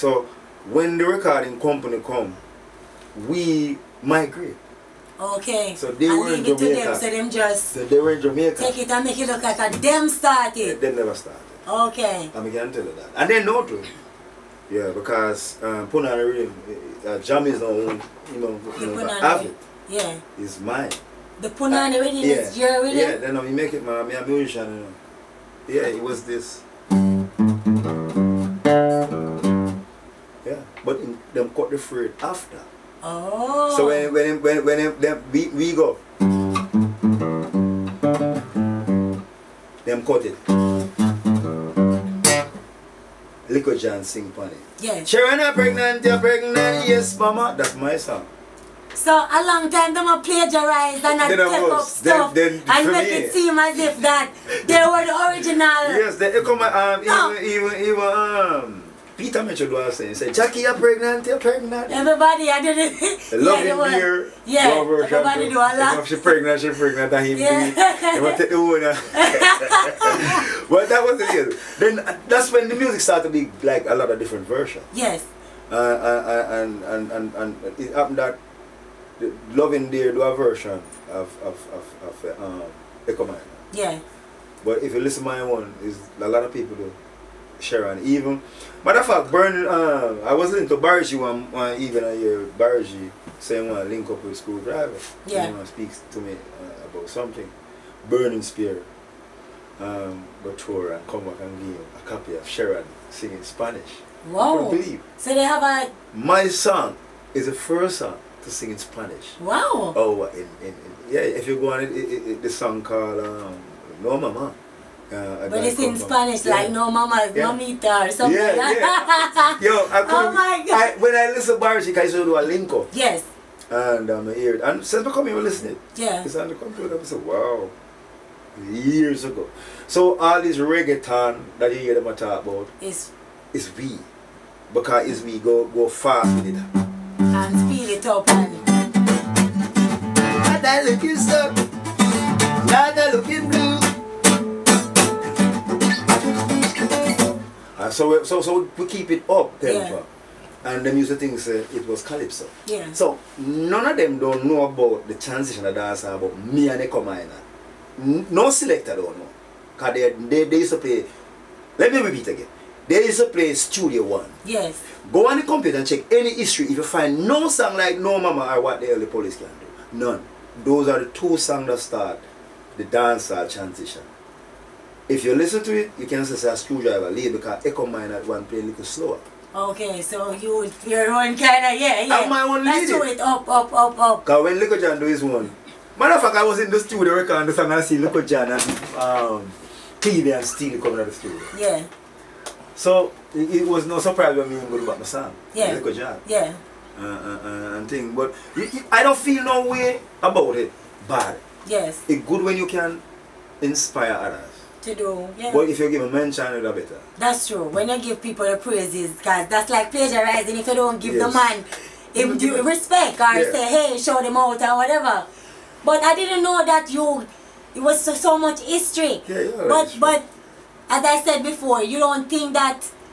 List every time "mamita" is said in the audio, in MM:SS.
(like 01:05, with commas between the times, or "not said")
01:57.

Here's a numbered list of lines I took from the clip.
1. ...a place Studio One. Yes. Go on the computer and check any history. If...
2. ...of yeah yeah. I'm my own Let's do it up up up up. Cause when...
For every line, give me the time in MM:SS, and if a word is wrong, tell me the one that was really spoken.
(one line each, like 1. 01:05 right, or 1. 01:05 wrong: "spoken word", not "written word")
1. 02:43 right
2. 03:01 right.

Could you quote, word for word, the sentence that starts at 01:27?
Sharon, even matter of fact, Burn.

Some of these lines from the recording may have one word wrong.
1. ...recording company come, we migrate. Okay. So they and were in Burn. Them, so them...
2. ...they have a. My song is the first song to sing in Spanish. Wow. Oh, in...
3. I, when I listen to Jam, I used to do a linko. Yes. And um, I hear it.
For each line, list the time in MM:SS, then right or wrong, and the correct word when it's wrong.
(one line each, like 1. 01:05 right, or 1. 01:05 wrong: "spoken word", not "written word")
1. 00:01 wrong: "Jamaica", not "Burn"
2. 01:45 right
3. 02:00 wrong: "Barashik", not "Jam".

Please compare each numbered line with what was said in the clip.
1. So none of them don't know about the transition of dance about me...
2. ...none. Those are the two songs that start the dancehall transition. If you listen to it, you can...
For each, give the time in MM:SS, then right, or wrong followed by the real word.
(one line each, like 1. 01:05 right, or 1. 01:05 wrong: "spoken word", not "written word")
1. 02:32 right
2. 02:50 right.